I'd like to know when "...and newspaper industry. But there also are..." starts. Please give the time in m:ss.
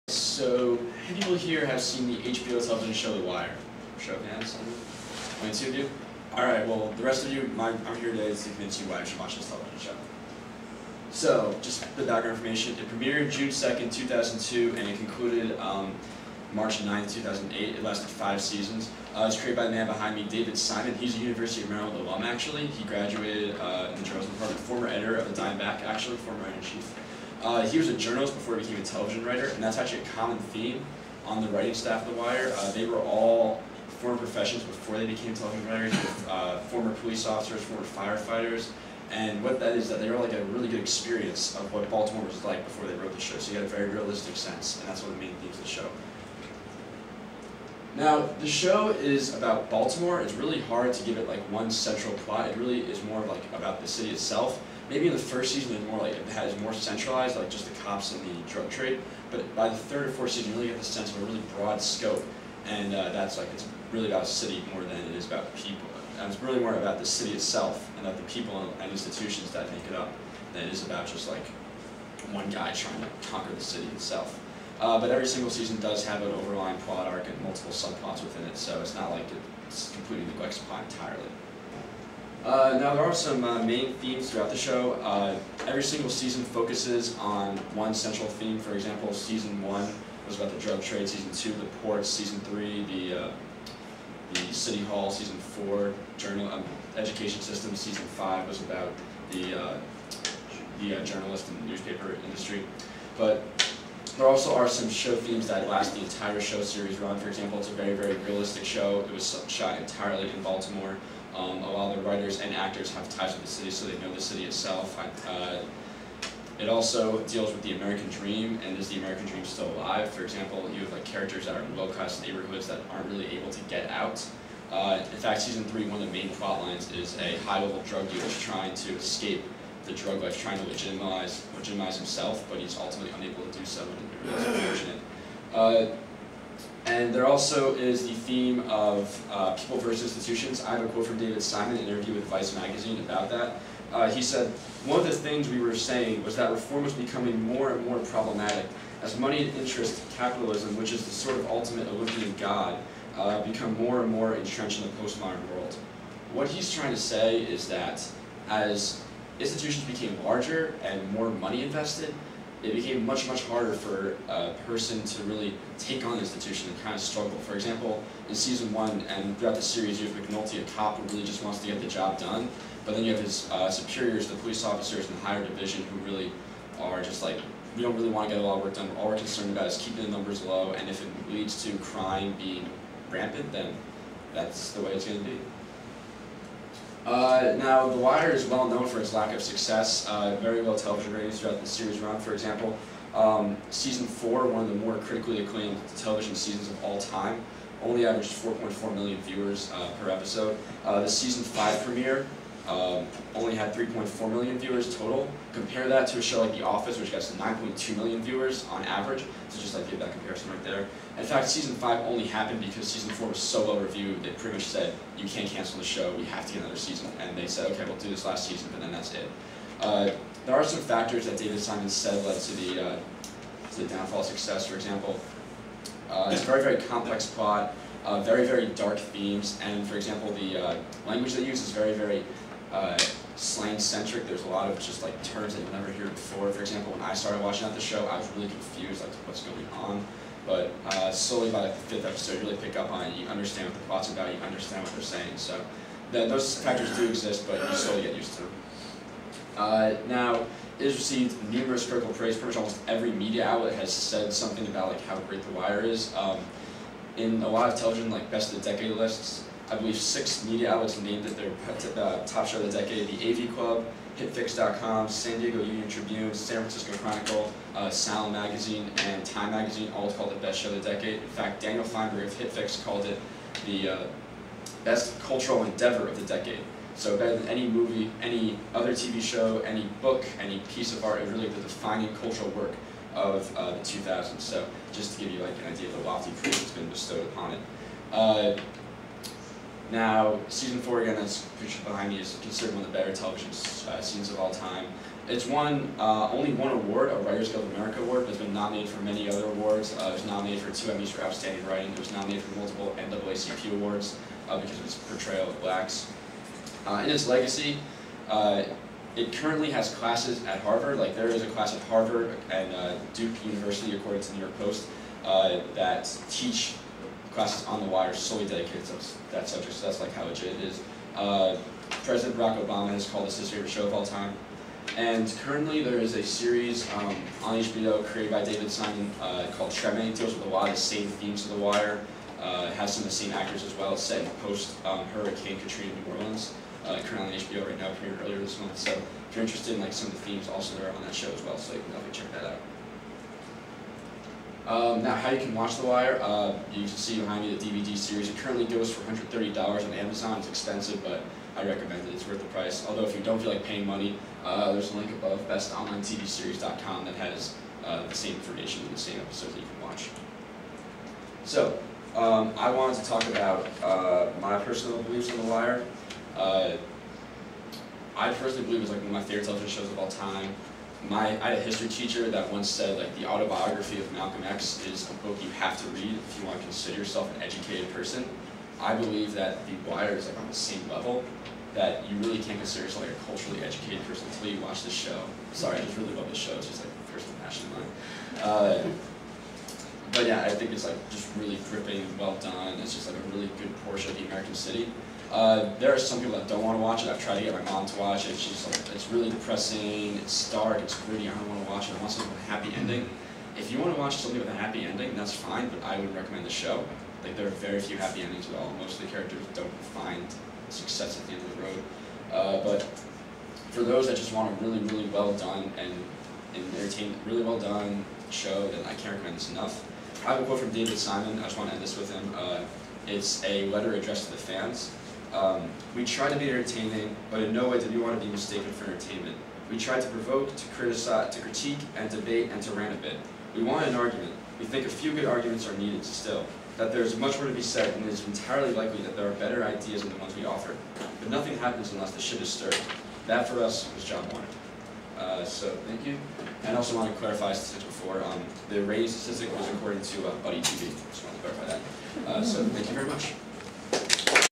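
1:41.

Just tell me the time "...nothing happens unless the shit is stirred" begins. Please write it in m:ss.
7:21.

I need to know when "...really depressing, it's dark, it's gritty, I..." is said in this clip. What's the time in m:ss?
6:39.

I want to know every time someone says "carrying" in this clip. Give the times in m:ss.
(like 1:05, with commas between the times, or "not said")
not said.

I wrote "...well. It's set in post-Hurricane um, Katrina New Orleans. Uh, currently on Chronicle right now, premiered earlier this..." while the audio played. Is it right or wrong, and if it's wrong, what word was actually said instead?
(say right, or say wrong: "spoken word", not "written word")
wrong: "HBO", not "Chronicle".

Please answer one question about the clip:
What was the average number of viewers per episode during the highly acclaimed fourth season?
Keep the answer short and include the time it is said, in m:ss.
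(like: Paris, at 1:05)
4.4 million, at 3:18.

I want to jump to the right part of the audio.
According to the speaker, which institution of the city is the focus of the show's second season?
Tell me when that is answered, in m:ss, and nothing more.
1:31.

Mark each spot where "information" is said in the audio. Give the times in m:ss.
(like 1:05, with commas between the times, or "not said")
0:12, 5:58.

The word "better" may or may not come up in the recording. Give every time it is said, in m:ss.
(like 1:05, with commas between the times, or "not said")
4:37, 4:52, 7:19.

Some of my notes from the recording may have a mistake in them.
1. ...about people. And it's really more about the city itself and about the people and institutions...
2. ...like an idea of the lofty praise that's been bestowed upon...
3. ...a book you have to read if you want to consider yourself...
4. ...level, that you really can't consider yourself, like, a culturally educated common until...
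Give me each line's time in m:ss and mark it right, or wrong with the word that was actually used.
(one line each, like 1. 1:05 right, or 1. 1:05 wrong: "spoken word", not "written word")
1. 1:05 right
2. 4:45 right
3. 6:15 right
4. 6:20 wrong: "person", not "common".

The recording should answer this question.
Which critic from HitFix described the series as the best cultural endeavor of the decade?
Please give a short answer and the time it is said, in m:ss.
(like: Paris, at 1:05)
Daniel Fienberg, at 4:31.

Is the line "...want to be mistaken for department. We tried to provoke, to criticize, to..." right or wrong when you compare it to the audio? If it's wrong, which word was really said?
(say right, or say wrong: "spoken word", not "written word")
wrong: "entertainment", not "department".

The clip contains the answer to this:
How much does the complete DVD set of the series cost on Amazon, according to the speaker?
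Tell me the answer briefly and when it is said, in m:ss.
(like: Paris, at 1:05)
$130, at 5:49.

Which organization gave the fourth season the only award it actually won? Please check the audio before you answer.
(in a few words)
Writers Guild of America.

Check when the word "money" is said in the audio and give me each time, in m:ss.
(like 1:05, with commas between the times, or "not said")
2:29, 2:41, 5:53.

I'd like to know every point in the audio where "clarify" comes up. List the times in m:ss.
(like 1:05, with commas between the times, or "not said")
7:27, 7:31.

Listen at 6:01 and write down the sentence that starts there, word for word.
So, um, I wanted to talk about uh, my personal beliefs on The Wire.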